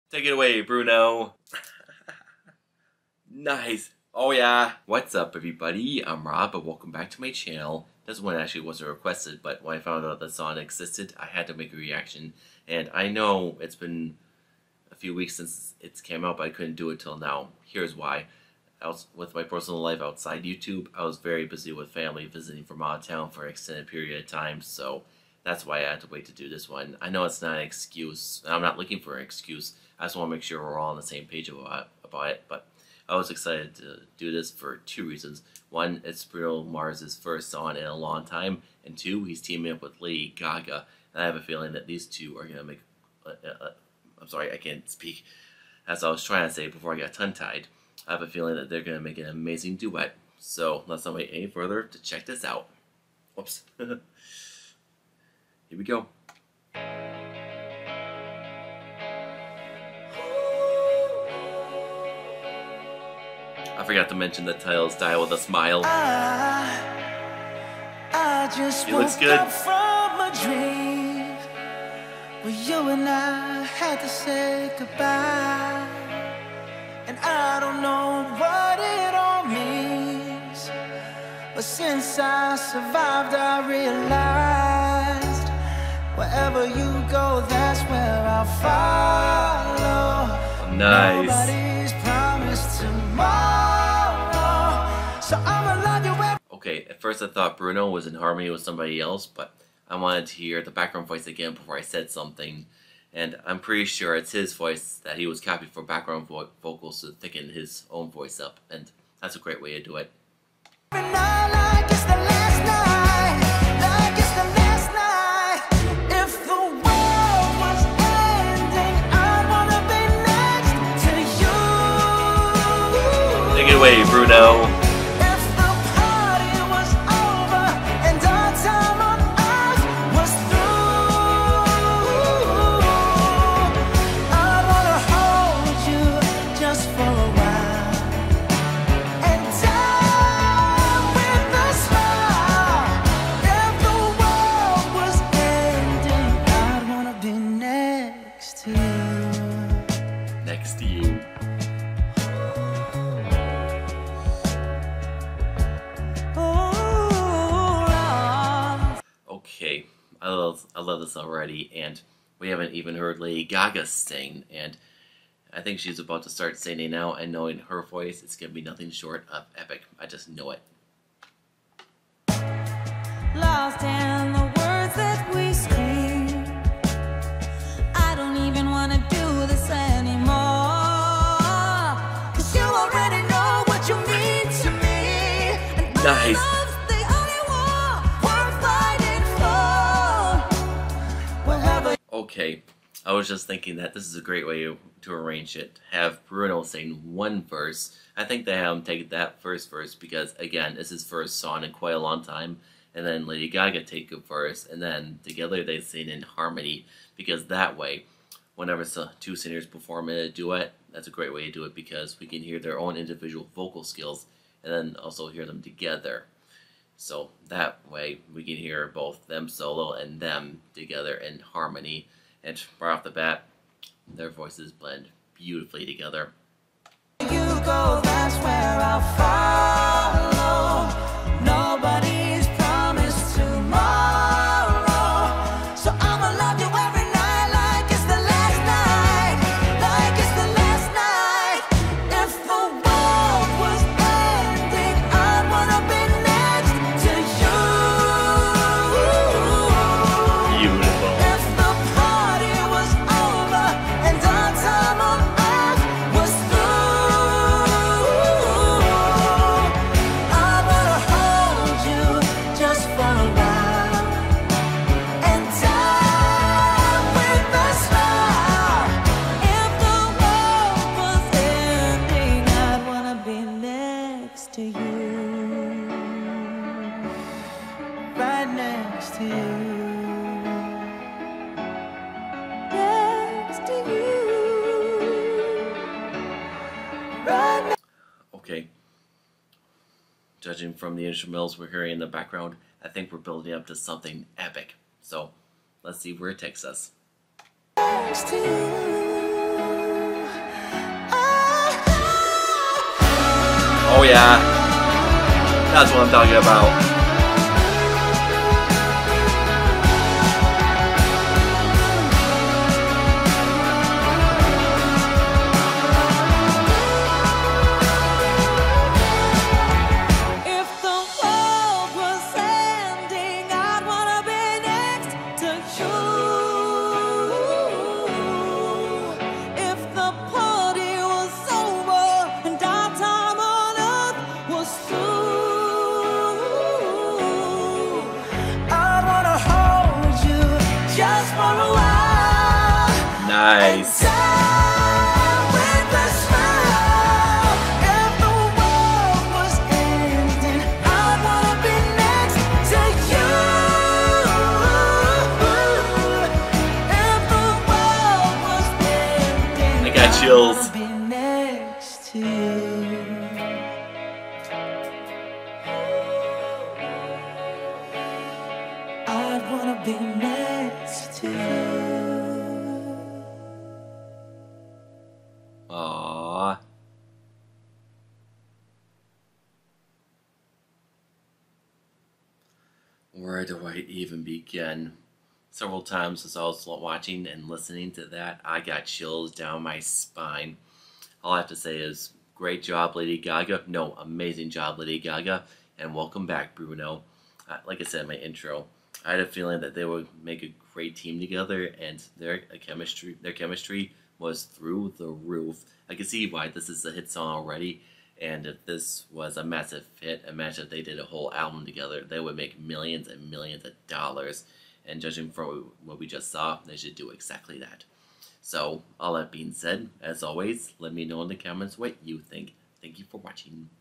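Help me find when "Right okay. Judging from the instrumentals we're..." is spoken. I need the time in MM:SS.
04:47.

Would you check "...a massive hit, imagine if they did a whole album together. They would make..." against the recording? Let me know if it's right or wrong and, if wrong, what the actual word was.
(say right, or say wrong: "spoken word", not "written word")
right.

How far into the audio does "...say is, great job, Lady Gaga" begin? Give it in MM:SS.
06:31.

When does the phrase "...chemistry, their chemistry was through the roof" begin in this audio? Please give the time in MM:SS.
06:42.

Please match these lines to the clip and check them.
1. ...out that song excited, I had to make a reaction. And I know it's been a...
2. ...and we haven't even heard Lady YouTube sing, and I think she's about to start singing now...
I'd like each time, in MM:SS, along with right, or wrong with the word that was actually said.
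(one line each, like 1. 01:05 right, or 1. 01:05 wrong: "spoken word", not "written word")
1. 00:10 wrong: "existed", not "excited"
2. 02:41 wrong: "Gaga", not "YouTube".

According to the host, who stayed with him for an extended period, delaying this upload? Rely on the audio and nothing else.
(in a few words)
Family.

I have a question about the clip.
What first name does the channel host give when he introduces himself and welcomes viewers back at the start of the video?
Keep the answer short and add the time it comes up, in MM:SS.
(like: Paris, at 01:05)
Rob, at 00:06.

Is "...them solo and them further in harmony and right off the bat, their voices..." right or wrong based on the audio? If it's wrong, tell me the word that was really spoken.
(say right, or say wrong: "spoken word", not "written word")
wrong: "together", not "further".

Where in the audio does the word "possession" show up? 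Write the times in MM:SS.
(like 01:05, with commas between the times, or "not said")
not said.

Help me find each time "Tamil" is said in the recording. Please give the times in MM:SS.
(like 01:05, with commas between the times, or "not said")
not said.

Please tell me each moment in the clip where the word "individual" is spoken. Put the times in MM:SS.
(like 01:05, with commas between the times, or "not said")
03:32.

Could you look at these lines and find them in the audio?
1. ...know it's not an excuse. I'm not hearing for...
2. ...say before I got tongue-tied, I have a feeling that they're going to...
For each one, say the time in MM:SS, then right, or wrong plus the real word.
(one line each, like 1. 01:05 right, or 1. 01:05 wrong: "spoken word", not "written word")
1. 00:27 wrong: "looking", not "hearing"
2. 00:46 right.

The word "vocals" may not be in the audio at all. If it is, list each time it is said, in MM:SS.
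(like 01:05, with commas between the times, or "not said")
01:46, 03:33.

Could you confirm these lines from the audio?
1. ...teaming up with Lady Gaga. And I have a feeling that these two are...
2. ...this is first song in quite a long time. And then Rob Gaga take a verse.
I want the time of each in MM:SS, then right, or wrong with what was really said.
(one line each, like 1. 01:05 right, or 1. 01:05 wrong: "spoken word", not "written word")
1. 00:39 right
2. 03:20 wrong: "Lady", not "Rob".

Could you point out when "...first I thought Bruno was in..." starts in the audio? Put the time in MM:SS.
01:37.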